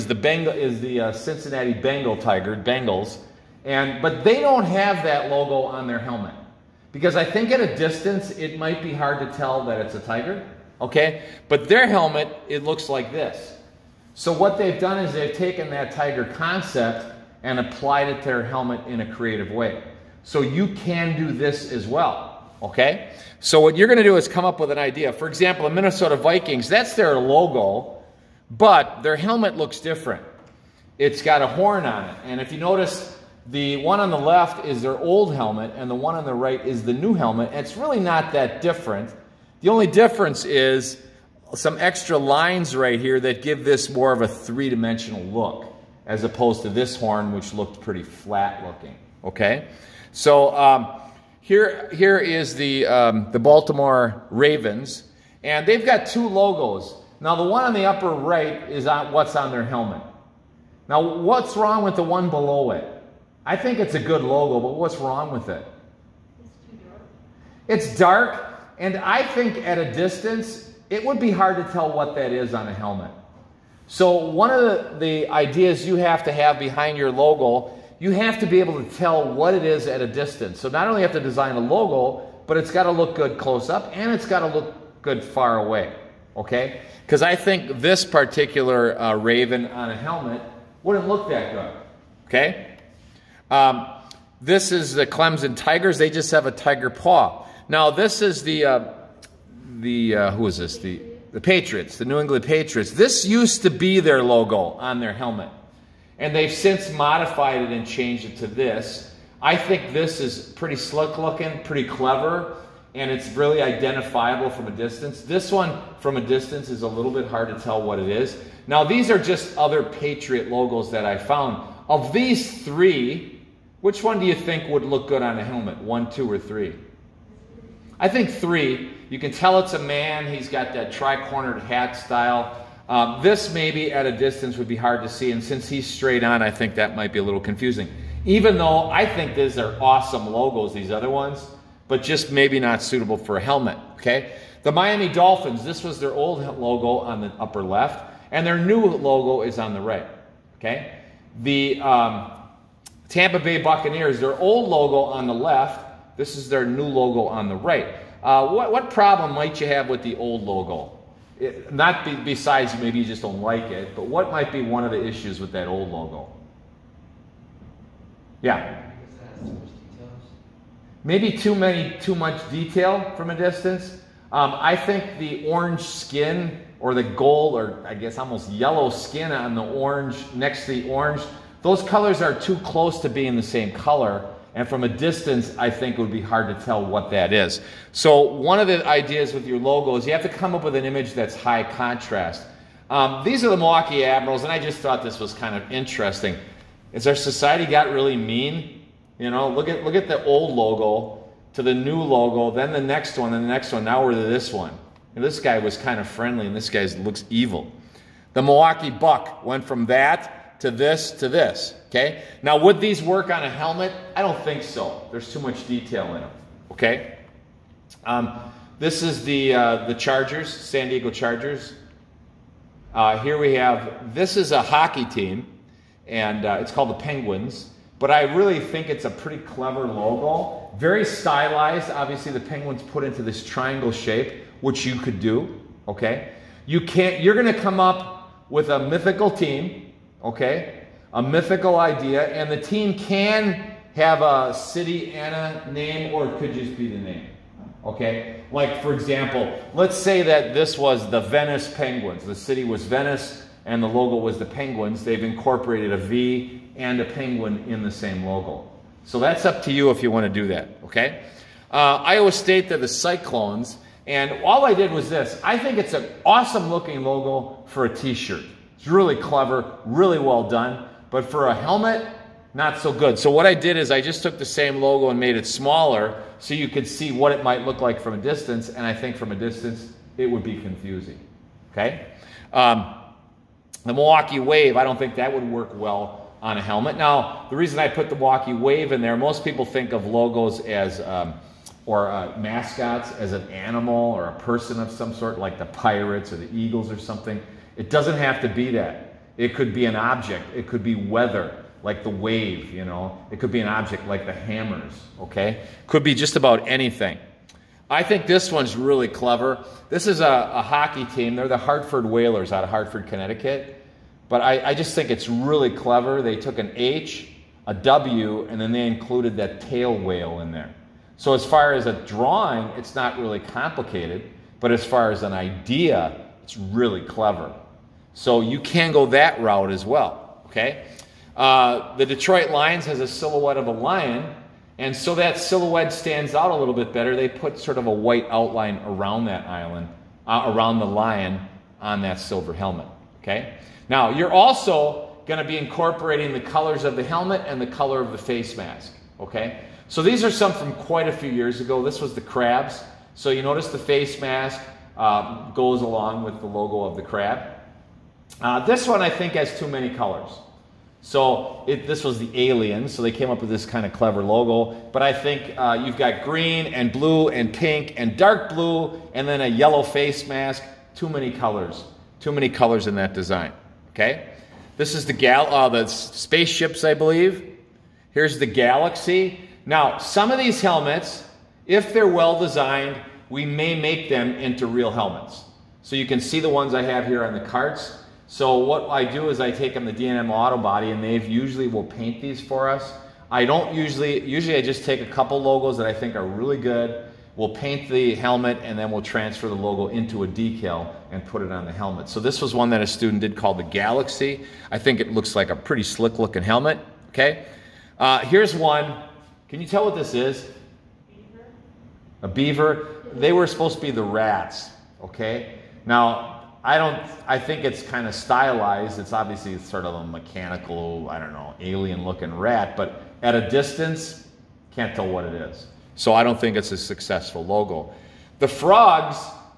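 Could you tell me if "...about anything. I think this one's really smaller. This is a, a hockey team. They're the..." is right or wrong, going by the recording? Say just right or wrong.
wrong.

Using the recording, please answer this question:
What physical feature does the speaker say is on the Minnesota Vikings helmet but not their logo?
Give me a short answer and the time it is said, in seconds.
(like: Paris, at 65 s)
A horn, at 31 s.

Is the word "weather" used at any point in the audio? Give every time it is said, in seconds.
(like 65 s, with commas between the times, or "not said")
300 s.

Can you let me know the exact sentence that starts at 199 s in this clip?
You know, look at look at the old logo to the new logo, then the next one, then the next one.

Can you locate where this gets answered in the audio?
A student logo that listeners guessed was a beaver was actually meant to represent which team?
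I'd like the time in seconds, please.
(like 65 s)
413 s.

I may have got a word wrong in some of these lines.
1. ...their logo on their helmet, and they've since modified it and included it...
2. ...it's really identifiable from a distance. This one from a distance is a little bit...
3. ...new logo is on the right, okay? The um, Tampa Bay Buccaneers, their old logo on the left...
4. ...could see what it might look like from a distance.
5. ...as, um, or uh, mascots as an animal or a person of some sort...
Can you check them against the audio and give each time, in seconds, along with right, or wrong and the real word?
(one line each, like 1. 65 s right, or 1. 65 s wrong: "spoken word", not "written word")
1. 104 s wrong: "changed", not "included"
2. 113 s right
3. 148 s right
4. 276 s right
5. 290 s right.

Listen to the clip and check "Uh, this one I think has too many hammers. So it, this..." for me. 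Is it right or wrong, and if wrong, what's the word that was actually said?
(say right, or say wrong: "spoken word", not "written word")
wrong: "colors", not "hammers".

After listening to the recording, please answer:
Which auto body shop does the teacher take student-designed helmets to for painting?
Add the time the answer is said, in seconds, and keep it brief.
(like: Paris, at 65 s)
DNM Auto Body, at 389 s.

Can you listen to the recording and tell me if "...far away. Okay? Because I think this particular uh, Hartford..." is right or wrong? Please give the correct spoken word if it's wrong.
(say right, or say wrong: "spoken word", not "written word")
wrong: "Raven", not "Hartford".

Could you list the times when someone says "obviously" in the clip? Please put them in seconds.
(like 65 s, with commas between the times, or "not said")
231 s, 419 s.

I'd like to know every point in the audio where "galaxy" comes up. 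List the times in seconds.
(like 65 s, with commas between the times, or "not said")
378 s, 403 s.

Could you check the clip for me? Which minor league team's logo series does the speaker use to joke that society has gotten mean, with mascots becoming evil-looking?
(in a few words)
Milwaukee Admirals.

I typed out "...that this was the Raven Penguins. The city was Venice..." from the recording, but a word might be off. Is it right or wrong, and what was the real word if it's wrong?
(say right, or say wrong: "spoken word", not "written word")
wrong: "Venice", not "Raven".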